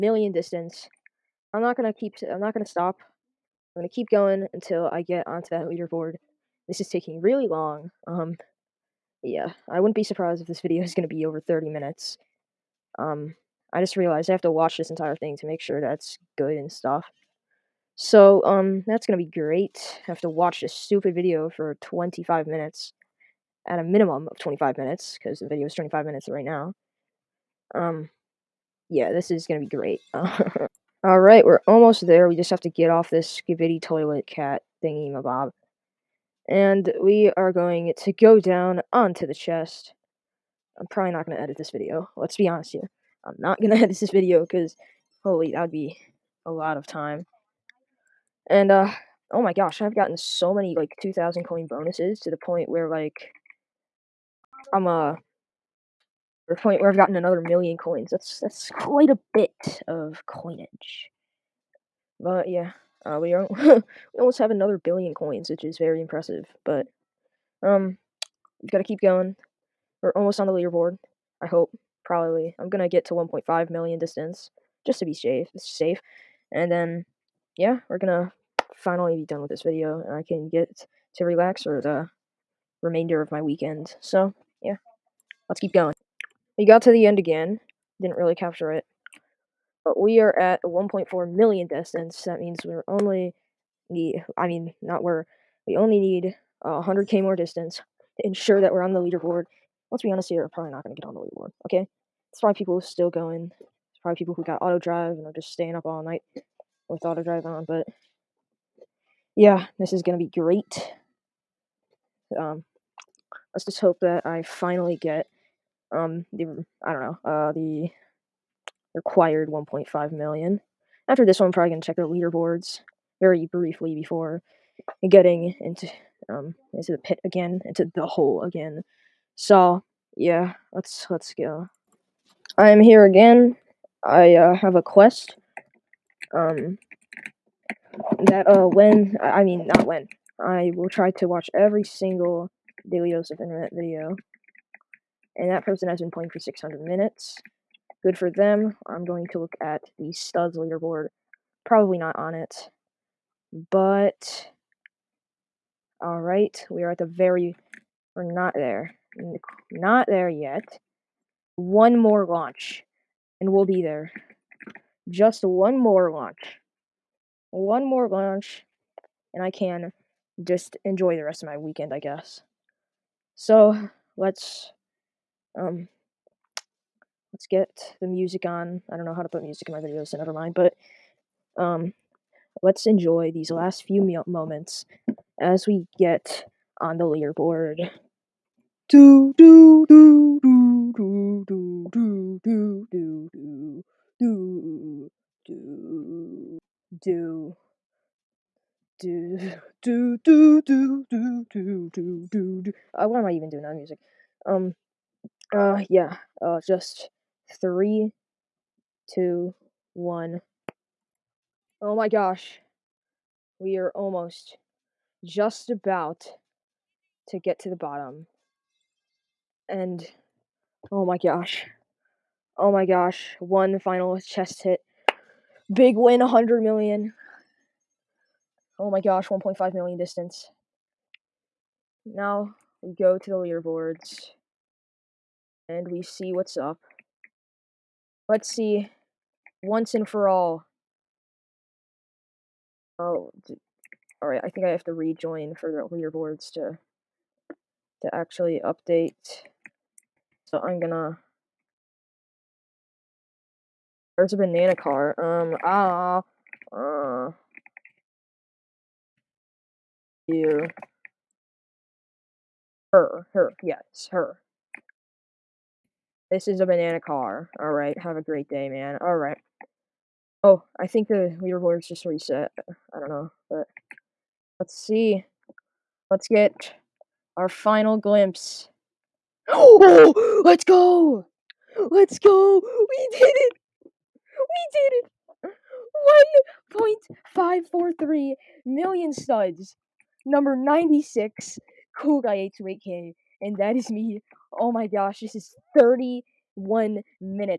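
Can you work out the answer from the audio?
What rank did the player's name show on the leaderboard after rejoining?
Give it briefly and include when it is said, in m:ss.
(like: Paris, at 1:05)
96, at 4:50.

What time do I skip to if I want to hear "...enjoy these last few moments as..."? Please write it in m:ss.
3:02.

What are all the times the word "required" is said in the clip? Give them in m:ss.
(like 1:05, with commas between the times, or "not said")
1:58.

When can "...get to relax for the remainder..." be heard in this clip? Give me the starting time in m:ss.
1:20.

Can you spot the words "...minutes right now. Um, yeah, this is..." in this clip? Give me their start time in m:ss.
0:26.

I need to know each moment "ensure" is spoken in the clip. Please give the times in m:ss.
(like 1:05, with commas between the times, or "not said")
1:38.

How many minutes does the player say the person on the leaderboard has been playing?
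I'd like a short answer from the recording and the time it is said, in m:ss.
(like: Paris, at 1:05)
600, at 2:26.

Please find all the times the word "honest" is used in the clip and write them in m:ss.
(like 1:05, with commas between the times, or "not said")
0:42, 1:40.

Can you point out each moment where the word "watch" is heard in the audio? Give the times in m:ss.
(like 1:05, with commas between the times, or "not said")
0:14, 0:20, 2:21.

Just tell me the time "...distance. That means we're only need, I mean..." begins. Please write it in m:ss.
1:31.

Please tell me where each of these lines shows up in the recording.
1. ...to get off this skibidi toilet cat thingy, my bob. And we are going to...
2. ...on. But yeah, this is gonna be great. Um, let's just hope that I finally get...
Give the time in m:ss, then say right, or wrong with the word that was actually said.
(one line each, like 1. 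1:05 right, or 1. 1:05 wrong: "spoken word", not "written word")
1. 0:32 right
2. 1:47 right.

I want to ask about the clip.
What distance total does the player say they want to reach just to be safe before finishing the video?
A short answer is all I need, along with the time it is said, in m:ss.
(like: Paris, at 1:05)
1.5 million, at 1:13.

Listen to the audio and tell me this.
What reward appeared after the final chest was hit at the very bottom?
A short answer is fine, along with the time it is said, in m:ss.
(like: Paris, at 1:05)
100 million, at 3:45.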